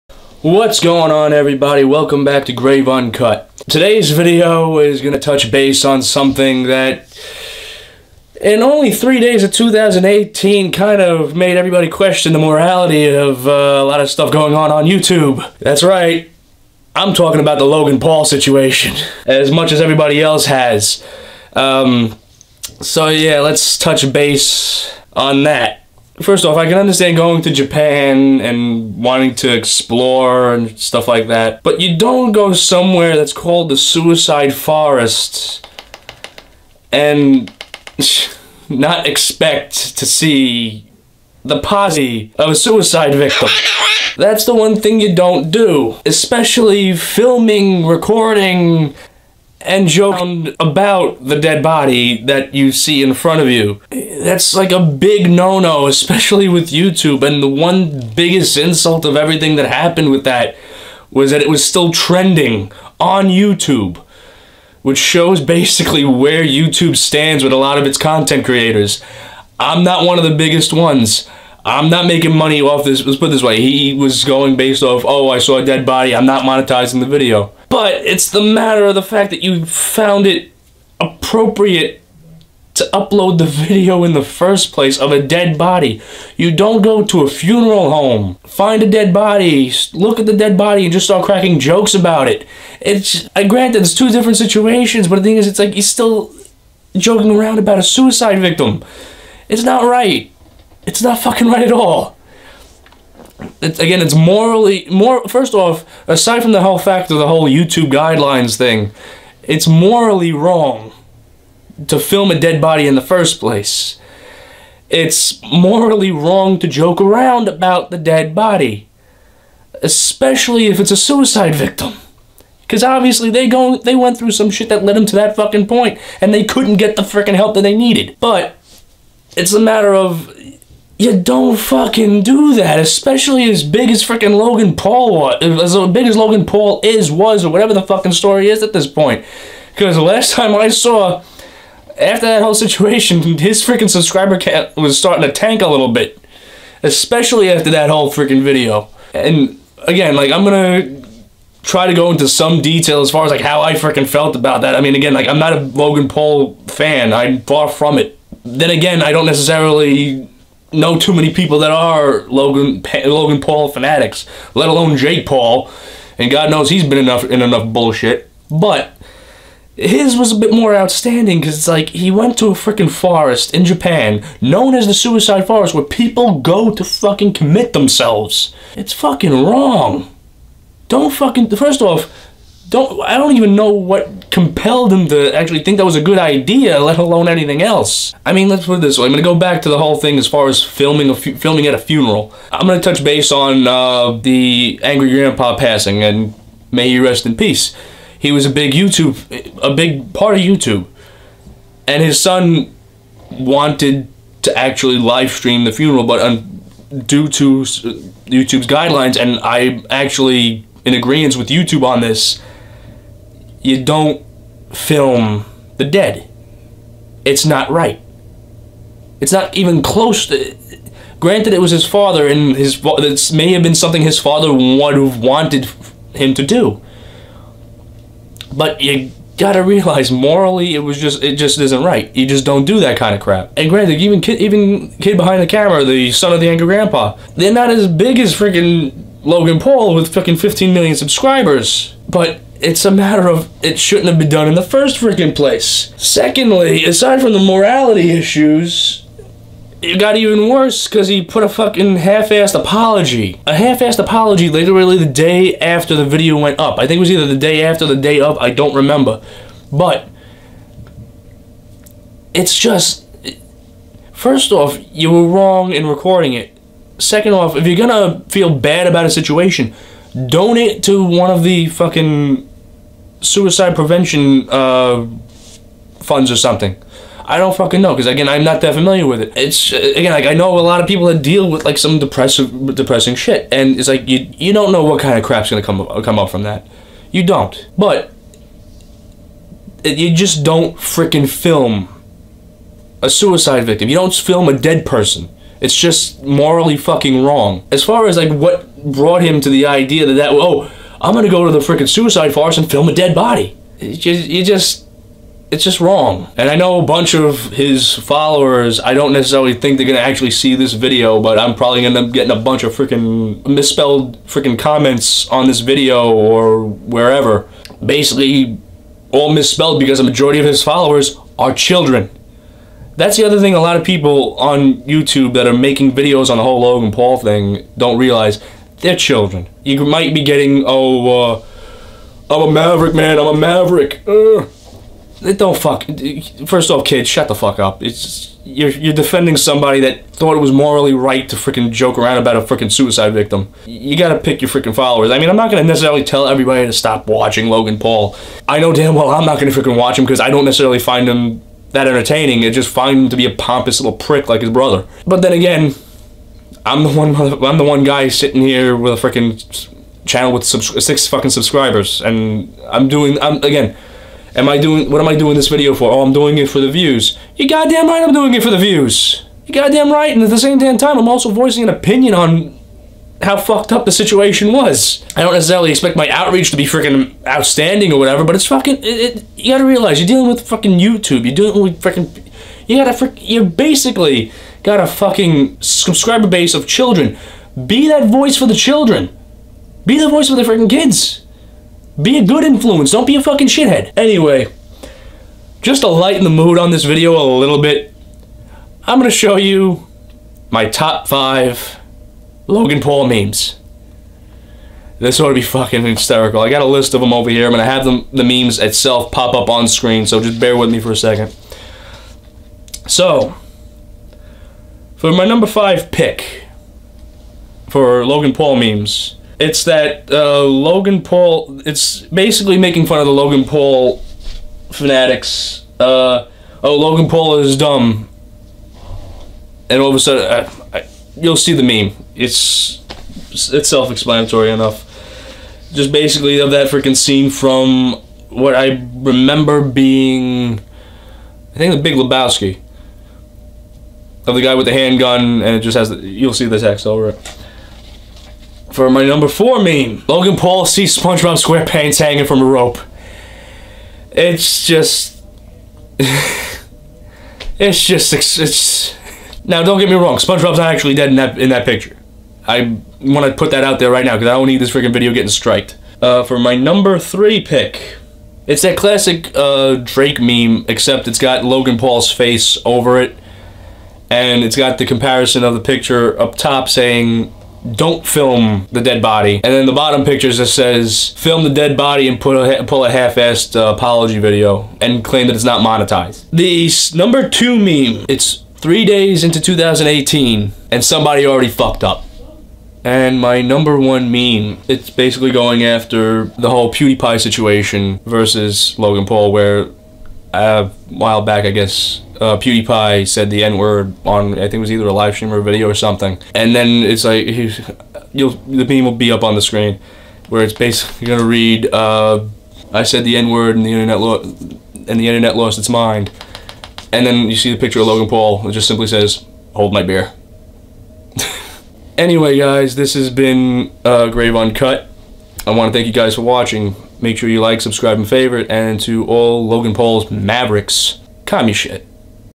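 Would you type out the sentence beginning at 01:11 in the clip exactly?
I'm not making money off this.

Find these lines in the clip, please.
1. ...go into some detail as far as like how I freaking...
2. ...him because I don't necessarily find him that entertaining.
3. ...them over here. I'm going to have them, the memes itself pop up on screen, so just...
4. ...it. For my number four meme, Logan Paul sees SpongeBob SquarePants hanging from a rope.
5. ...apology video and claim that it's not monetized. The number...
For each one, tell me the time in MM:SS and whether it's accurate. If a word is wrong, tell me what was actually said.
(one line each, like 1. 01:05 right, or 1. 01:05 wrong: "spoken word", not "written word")
1. 02:31 right
2. 05:49 right
3. 06:47 right
4. 07:27 right
5. 08:03 right.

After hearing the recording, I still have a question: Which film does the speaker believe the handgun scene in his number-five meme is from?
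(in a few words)
The Big Lebowski.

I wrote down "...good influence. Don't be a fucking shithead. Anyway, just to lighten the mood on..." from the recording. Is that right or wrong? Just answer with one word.
right.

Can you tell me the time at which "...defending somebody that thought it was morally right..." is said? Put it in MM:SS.
05:38.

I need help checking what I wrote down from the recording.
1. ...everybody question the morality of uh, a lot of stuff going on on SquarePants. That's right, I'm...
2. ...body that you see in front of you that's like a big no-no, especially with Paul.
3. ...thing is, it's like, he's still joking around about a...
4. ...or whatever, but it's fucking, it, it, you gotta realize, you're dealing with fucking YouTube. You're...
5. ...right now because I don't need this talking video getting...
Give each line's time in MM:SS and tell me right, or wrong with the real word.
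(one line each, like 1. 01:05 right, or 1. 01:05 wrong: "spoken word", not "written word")
1. 00:11 wrong: "YouTube", not "SquarePants"
2. 00:51 wrong: "YouTube", not "Paul"
3. 01:35 right
4. 06:17 right
5. 07:43 wrong: "freaking", not "talking".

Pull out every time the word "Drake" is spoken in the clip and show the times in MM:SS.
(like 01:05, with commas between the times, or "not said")
07:49.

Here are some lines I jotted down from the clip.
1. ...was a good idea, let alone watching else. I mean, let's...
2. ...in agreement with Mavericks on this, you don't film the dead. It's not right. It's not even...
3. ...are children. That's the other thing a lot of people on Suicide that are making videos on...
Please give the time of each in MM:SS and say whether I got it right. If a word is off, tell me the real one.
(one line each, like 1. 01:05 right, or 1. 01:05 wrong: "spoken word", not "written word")
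1. 03:05 wrong: "anything", not "watching"
2. 03:30 wrong: "YouTube", not "Mavericks"
3. 05:21 wrong: "YouTube", not "Suicide".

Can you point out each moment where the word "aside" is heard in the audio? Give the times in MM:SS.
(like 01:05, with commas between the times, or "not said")
01:46, 04:06.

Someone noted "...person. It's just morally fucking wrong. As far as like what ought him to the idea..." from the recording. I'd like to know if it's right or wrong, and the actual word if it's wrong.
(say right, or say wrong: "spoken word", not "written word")
wrong: "brought", not "ought".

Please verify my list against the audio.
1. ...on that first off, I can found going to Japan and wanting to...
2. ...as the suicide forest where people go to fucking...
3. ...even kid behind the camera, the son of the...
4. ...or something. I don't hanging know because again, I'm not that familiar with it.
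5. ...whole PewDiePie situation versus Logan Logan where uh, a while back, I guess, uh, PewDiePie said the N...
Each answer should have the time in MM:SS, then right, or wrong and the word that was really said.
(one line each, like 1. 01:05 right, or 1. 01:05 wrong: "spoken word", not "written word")
1. 00:25 wrong: "understand", not "found"
2. 02:54 right
3. 03:54 right
4. 04:36 wrong: "fucking", not "hanging"
5. 08:16 wrong: "Paul", not "Logan".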